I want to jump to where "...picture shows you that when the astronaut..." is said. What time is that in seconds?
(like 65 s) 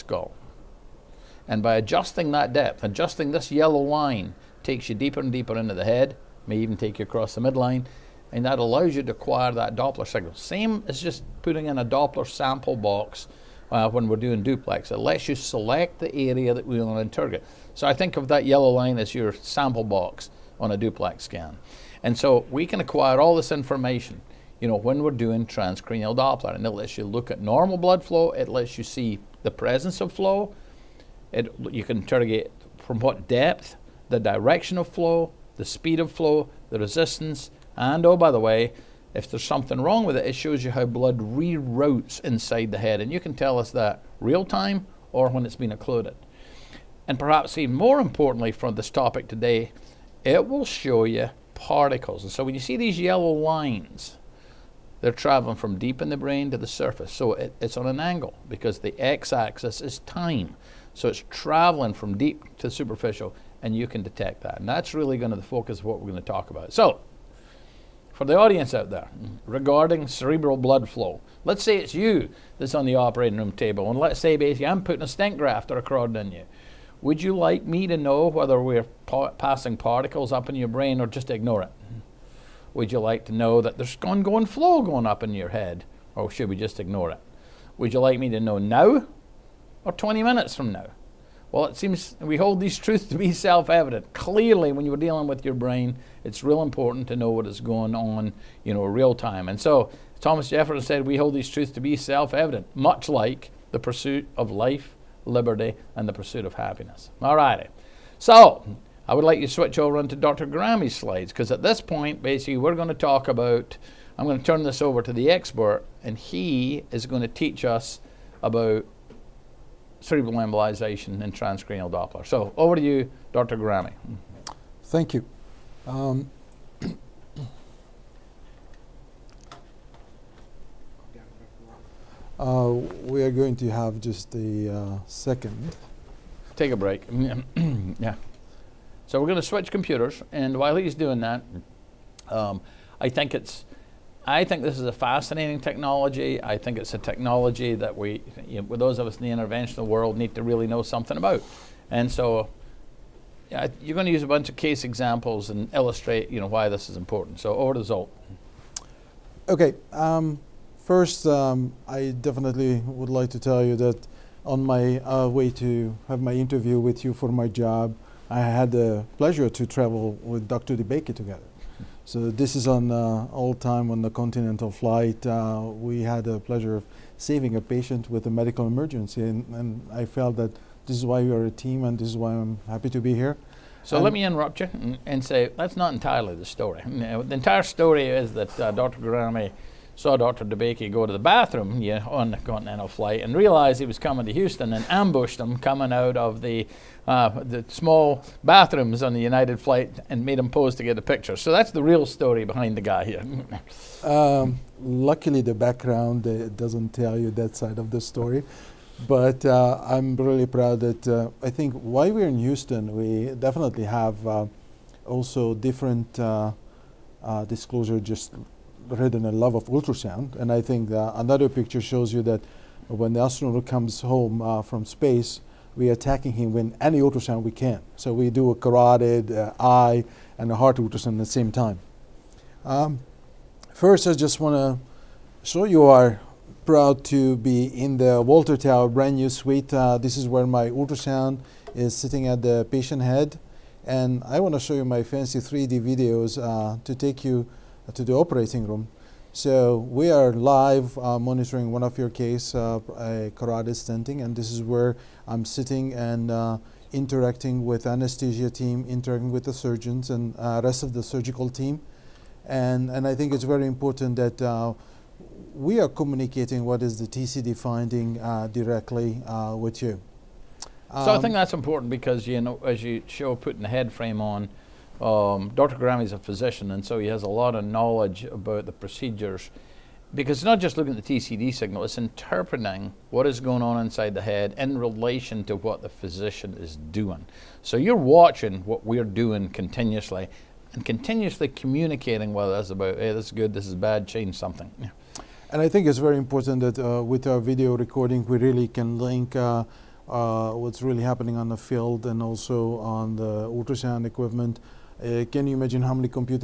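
221 s.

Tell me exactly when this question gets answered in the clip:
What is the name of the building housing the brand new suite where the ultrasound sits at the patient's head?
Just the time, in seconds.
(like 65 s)
238 s.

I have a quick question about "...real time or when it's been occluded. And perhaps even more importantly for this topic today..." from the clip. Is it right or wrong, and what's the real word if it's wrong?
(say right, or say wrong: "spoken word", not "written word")
right.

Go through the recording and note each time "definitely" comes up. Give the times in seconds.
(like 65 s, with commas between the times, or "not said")
162 s, 213 s.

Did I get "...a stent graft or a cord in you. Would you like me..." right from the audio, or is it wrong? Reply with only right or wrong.
right.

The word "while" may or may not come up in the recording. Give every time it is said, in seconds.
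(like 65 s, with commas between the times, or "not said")
140 s, 211 s.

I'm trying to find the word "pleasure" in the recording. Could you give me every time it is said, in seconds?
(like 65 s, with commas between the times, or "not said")
169 s, 176 s.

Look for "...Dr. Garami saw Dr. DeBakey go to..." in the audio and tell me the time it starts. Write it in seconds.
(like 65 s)
188 s.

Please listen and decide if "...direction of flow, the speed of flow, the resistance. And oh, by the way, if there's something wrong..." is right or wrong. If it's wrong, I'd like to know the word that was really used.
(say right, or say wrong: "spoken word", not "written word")
right.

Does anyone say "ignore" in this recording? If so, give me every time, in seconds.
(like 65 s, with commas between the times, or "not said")
81 s, 86 s.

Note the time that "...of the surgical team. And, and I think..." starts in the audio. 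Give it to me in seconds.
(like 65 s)
260 s.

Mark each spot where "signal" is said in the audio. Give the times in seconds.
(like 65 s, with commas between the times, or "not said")
10 s, 281 s.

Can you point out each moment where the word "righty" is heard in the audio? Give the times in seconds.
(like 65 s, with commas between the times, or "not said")
107 s.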